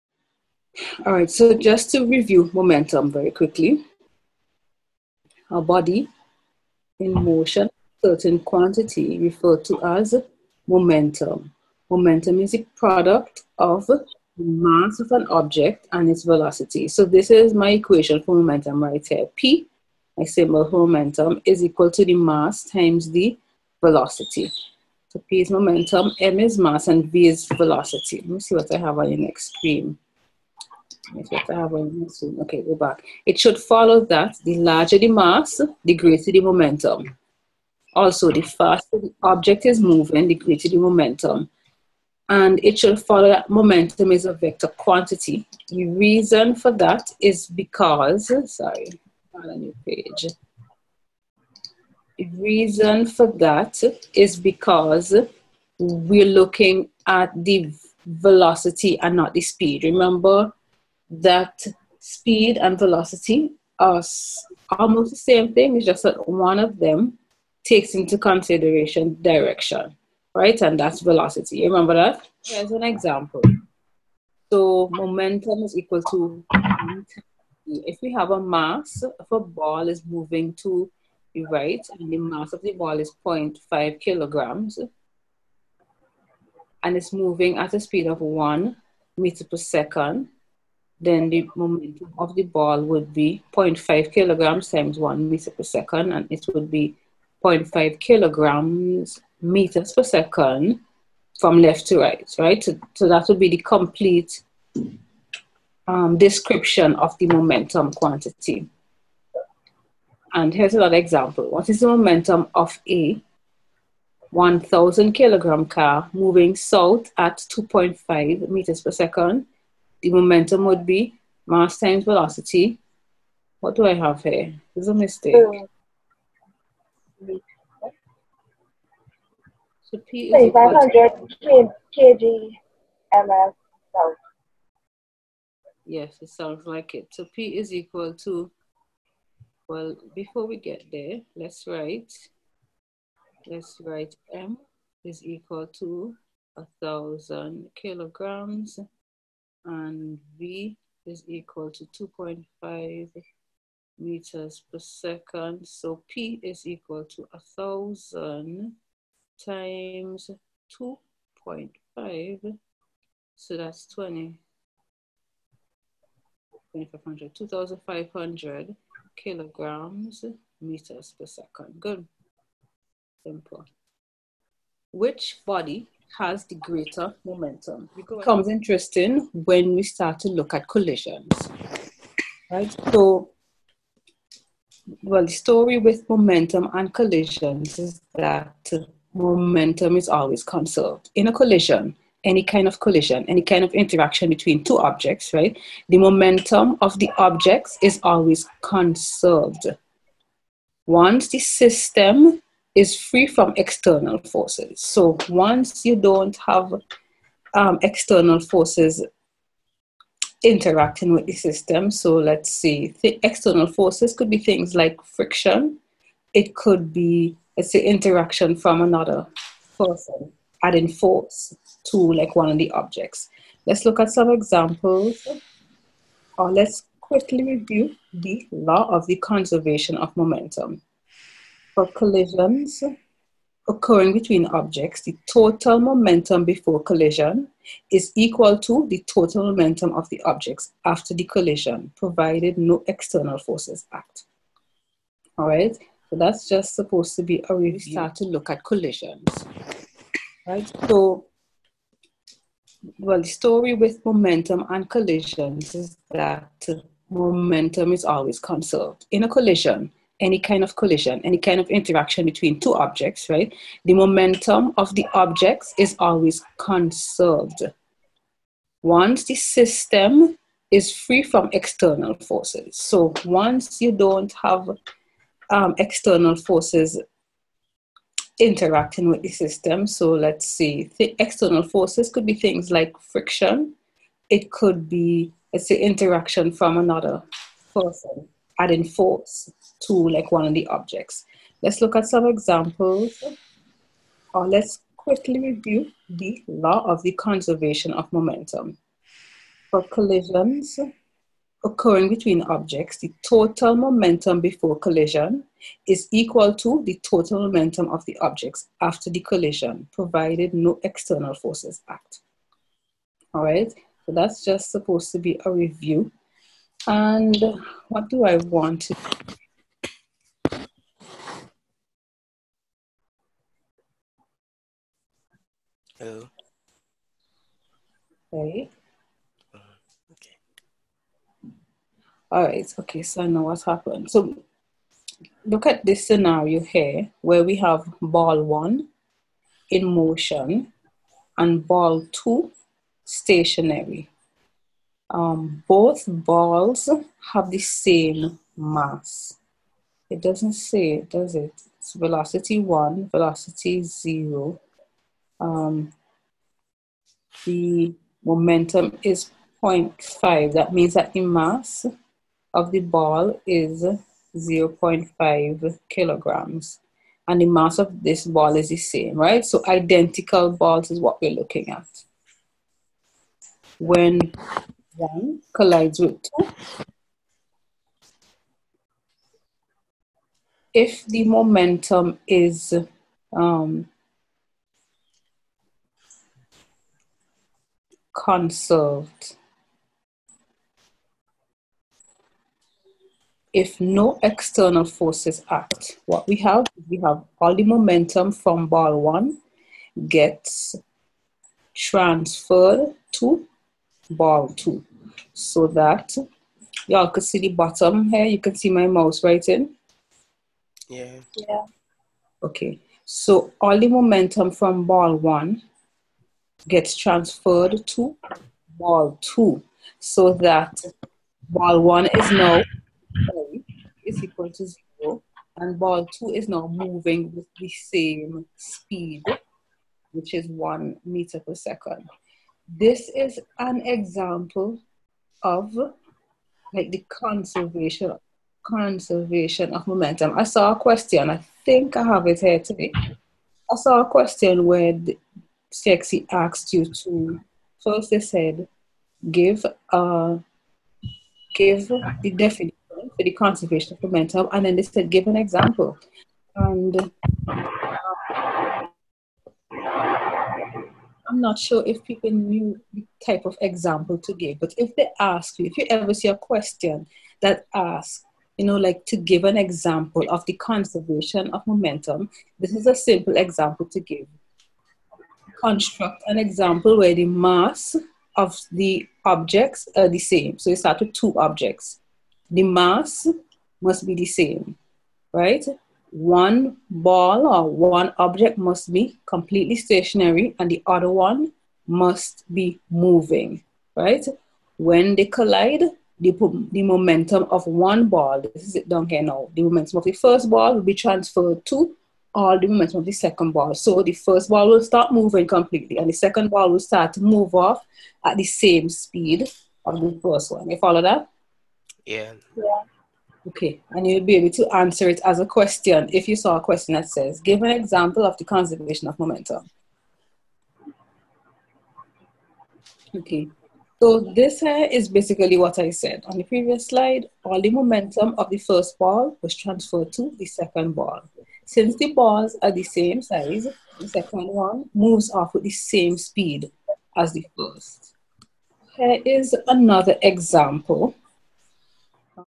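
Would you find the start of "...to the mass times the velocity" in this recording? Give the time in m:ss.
0:21.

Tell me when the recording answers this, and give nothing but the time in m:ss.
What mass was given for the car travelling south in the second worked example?
1:54.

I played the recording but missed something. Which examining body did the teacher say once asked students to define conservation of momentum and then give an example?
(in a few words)
CSEC.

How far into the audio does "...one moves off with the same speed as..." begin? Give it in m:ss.
8:54.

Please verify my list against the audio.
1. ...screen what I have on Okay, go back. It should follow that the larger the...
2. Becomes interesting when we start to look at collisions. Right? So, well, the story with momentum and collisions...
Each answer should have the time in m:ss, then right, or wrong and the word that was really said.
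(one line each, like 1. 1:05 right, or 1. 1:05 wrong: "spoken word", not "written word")
1. 0:29 right
2. 2:57 right.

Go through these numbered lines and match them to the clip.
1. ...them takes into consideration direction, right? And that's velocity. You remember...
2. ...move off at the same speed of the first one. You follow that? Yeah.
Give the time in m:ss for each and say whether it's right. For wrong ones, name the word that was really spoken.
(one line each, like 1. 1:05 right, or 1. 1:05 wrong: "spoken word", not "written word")
1. 1:06 right
2. 8:27 right.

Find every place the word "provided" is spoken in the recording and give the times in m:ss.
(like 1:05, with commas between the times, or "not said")
4:01, 5:09.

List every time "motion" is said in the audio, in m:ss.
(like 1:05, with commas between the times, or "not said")
0:07, 5:39.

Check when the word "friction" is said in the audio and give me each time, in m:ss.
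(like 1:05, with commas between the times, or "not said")
3:35, 4:42.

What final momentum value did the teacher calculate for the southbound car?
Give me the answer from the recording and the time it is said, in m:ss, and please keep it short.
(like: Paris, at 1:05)
2,500 kilograms meters per second, at 2:47.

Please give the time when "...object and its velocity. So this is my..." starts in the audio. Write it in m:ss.
0:15.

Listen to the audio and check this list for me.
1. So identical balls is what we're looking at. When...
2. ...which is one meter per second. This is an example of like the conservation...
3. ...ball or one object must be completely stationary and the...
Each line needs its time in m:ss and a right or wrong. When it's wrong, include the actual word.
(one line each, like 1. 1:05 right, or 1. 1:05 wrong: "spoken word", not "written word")
1. 6:09 right
2. 7:10 right
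3. 8:06 right.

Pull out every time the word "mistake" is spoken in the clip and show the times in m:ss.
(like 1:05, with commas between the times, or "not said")
2:04.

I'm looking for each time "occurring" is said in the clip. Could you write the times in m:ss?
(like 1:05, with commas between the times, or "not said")
3:53, 5:01.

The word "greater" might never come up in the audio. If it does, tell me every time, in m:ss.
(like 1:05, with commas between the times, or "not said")
0:35, 0:40, 2:56.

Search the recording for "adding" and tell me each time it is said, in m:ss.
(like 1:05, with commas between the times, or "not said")
3:40, 4:48.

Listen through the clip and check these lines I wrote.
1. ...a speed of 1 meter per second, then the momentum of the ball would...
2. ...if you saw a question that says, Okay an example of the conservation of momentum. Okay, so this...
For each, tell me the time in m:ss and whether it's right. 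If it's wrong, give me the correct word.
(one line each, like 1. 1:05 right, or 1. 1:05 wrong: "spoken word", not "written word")
1. 1:27 right
2. 8:36 wrong: "Give", not "Okay".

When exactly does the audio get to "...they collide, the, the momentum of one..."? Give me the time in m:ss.
8:15.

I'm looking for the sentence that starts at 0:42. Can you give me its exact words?
And it should follow that momentum is a vector quantity.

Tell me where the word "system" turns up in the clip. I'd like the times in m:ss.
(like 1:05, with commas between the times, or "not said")
3:21, 3:31, 4:29, 4:39.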